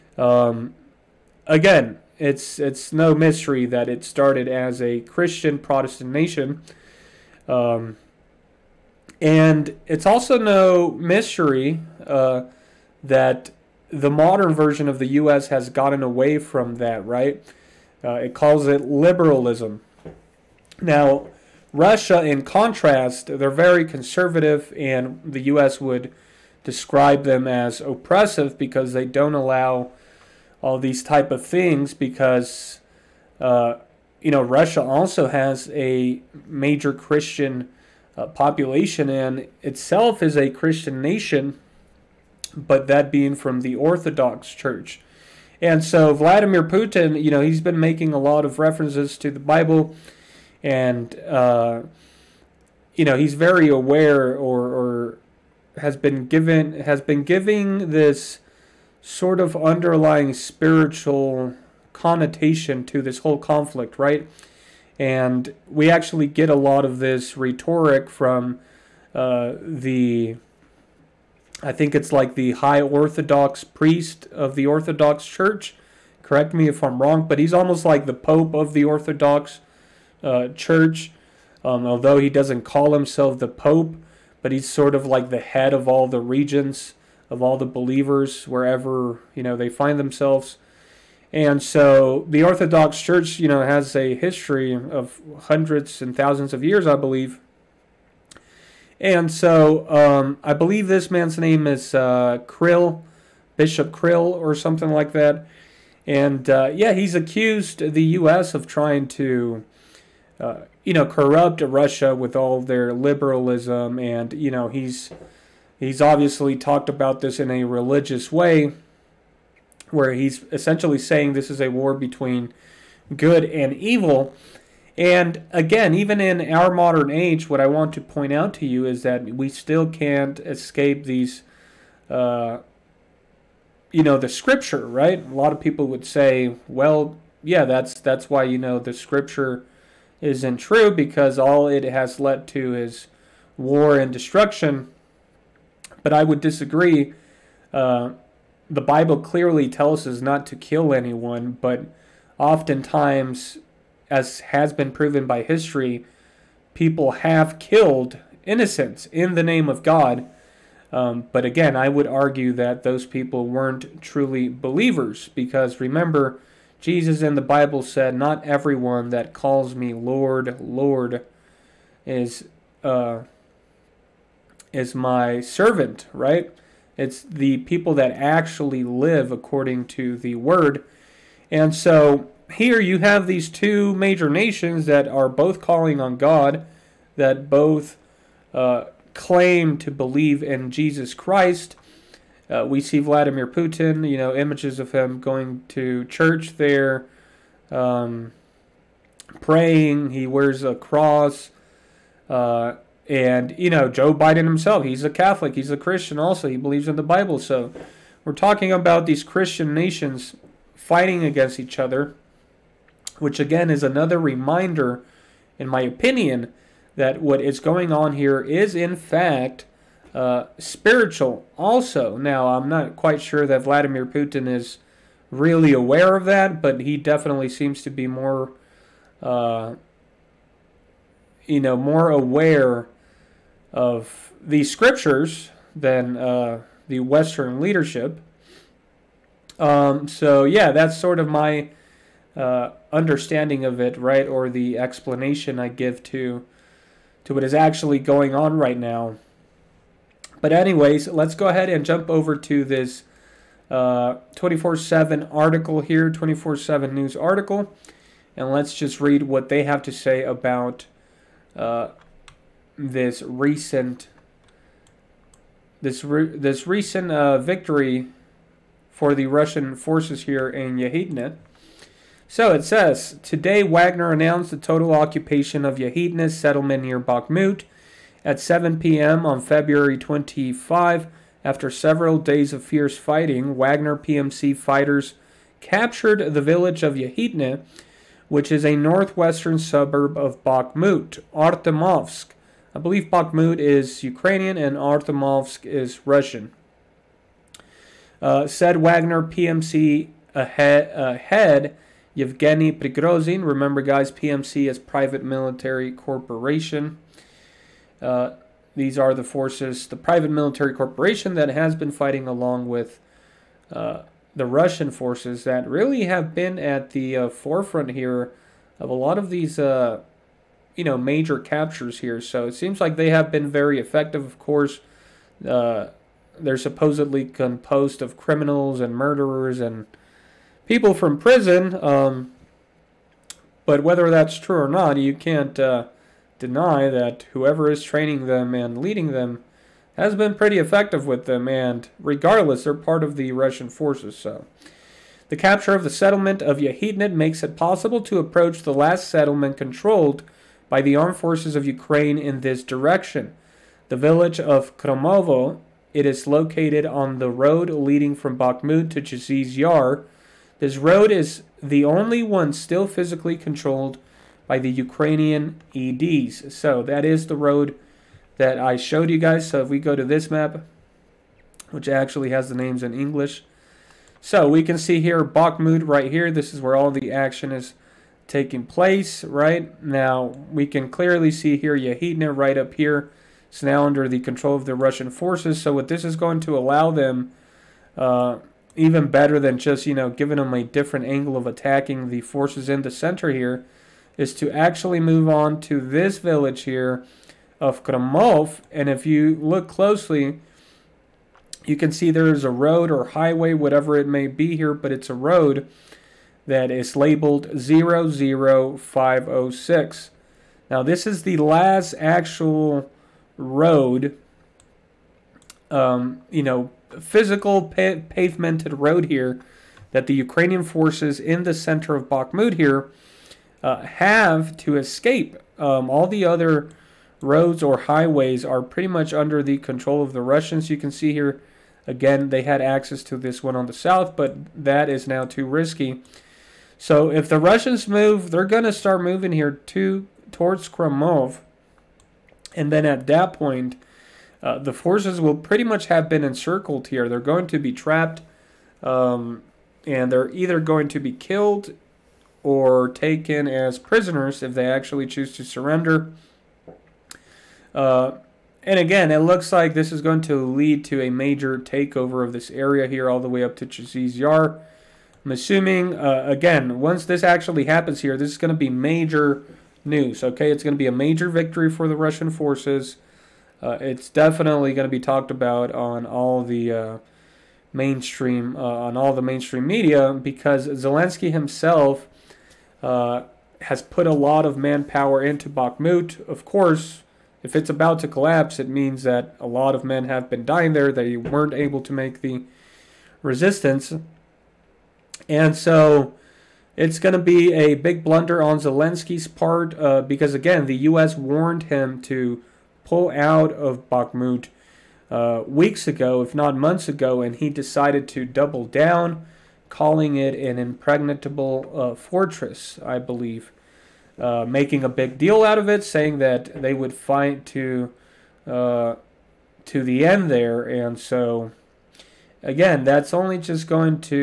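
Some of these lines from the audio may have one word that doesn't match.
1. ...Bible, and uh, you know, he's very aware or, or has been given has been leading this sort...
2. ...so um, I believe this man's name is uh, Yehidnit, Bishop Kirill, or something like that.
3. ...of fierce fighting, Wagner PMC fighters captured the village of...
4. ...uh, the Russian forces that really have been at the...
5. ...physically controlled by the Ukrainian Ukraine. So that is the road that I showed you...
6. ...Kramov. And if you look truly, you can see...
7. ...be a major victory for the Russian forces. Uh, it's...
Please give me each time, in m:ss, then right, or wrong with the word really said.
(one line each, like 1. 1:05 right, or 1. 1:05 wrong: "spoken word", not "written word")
1. 0:49 wrong: "giving", not "leading"
2. 1:39 wrong: "Kirill", not "Yehidnit"
3. 4:42 right
4. 5:13 right
5. 6:02 wrong: "EDs", not "Ukraine"
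6. 6:37 wrong: "closely", not "truly"
7. 7:50 right.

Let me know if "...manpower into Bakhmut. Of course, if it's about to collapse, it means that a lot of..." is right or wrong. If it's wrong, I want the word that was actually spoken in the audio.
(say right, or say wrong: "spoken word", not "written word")
right.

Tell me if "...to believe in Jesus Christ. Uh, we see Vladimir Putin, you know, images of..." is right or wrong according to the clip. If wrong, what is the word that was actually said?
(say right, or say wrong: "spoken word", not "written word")
right.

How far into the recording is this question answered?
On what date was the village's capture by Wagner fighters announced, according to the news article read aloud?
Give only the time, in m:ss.
4:39.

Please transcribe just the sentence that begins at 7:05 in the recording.
Um, all the other roads or highways are pretty much under the control of the Russians.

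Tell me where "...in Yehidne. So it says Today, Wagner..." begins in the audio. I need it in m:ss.
4:30.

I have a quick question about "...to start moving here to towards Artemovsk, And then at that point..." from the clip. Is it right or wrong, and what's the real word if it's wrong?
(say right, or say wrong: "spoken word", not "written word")
wrong: "Kramov", not "Artemovsk".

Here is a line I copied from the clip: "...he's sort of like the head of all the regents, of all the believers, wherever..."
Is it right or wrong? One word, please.
right.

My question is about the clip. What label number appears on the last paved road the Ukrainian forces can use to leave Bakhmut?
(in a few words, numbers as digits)
00506.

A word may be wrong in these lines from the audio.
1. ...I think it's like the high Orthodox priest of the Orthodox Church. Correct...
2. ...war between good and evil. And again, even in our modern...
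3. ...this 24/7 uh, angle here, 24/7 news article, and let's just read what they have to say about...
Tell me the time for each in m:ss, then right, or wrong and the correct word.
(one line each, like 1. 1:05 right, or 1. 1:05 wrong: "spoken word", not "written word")
1. 1:11 right
2. 2:01 right
3. 4:12 wrong: "article", not "angle".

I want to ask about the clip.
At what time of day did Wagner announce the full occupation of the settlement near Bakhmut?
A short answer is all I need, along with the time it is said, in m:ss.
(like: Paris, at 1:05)
7 p.m., at 4:38.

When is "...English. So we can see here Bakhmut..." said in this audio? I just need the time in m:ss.
6:12.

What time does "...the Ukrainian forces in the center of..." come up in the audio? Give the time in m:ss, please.
7:00.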